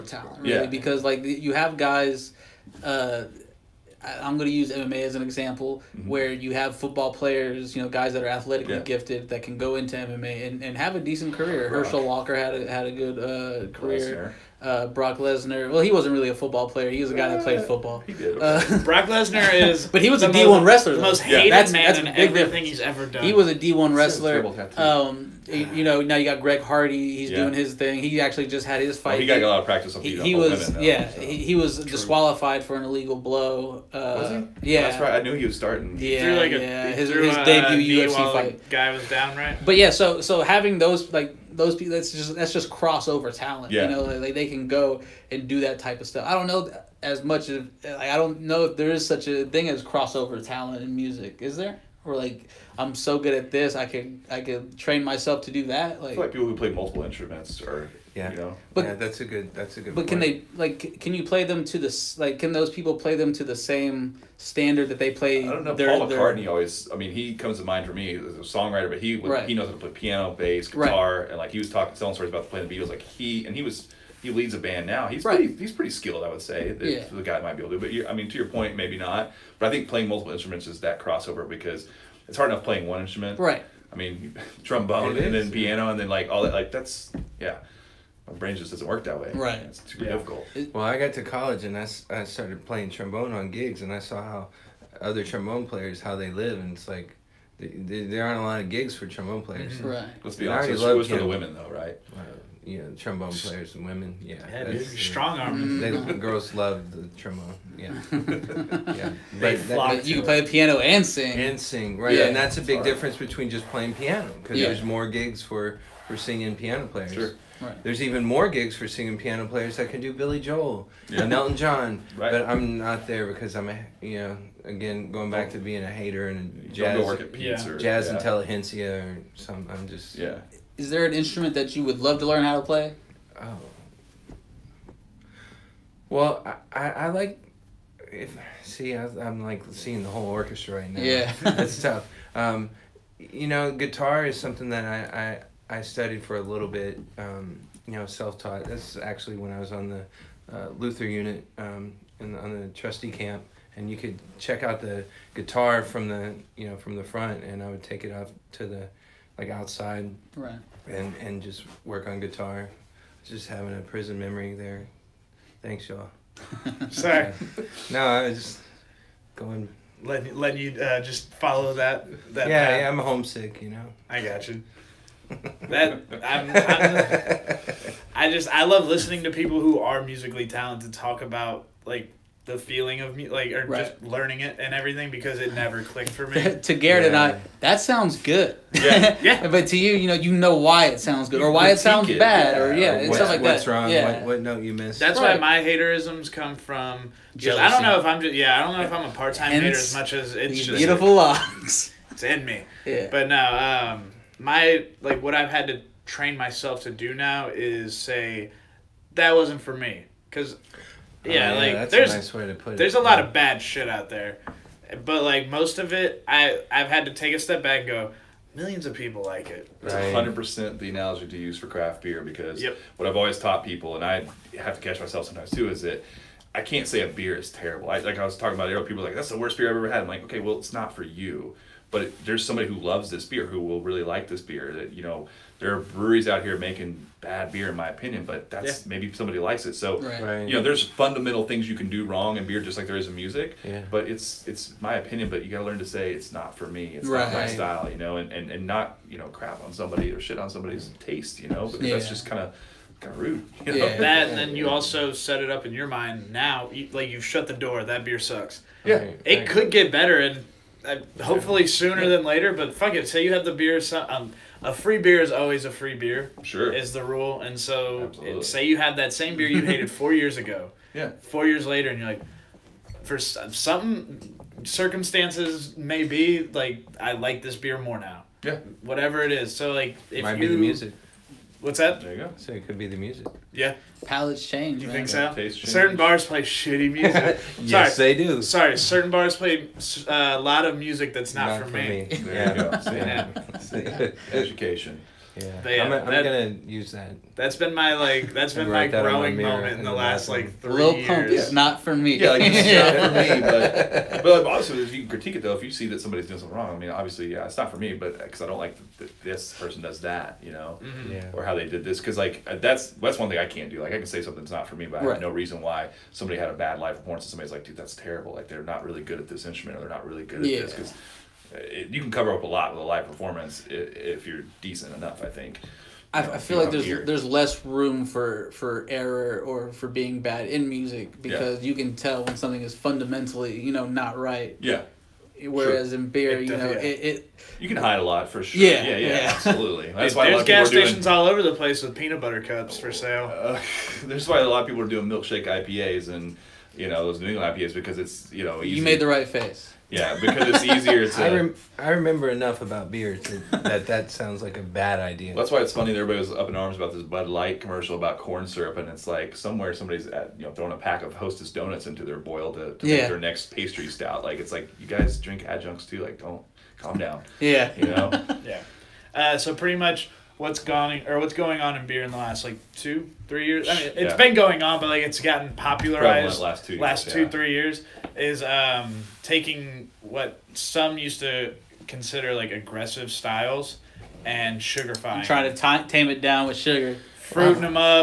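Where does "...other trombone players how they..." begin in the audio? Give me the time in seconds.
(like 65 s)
95 s.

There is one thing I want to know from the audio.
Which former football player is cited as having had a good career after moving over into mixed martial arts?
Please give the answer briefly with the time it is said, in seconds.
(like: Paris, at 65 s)
Herschel Walker, at 11 s.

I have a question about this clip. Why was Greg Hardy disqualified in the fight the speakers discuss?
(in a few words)
Illegal blow.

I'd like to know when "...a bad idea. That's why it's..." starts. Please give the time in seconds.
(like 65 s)
354 s.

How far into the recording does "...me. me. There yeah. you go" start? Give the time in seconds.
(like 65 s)
291 s.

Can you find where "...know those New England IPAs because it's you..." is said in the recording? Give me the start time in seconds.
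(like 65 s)
346 s.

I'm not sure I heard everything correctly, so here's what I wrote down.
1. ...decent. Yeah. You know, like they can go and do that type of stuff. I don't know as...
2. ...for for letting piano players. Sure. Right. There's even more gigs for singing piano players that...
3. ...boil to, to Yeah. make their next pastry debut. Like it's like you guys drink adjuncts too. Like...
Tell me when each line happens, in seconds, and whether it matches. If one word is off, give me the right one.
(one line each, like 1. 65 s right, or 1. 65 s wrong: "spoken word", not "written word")
1. 43 s wrong: "talent", not "decent"
2. 115 s wrong: "singing", not "letting"
3. 362 s wrong: "stout", not "debut".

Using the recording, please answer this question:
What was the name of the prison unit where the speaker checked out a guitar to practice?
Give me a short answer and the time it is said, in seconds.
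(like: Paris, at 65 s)
Luther unit, at 150 s.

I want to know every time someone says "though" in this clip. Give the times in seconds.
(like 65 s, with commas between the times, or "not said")
101 s, 305 s.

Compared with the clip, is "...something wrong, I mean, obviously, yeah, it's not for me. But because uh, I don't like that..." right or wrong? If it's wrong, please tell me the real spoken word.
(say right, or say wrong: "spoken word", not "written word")
right.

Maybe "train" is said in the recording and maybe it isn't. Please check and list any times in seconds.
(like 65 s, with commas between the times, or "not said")
54 s, 206 s.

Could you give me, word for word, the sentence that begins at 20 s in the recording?
The most hated that's, man that's in everything difference.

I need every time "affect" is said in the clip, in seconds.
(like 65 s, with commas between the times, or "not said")
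not said.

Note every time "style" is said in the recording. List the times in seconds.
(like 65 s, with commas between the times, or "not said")
247 s, 383 s.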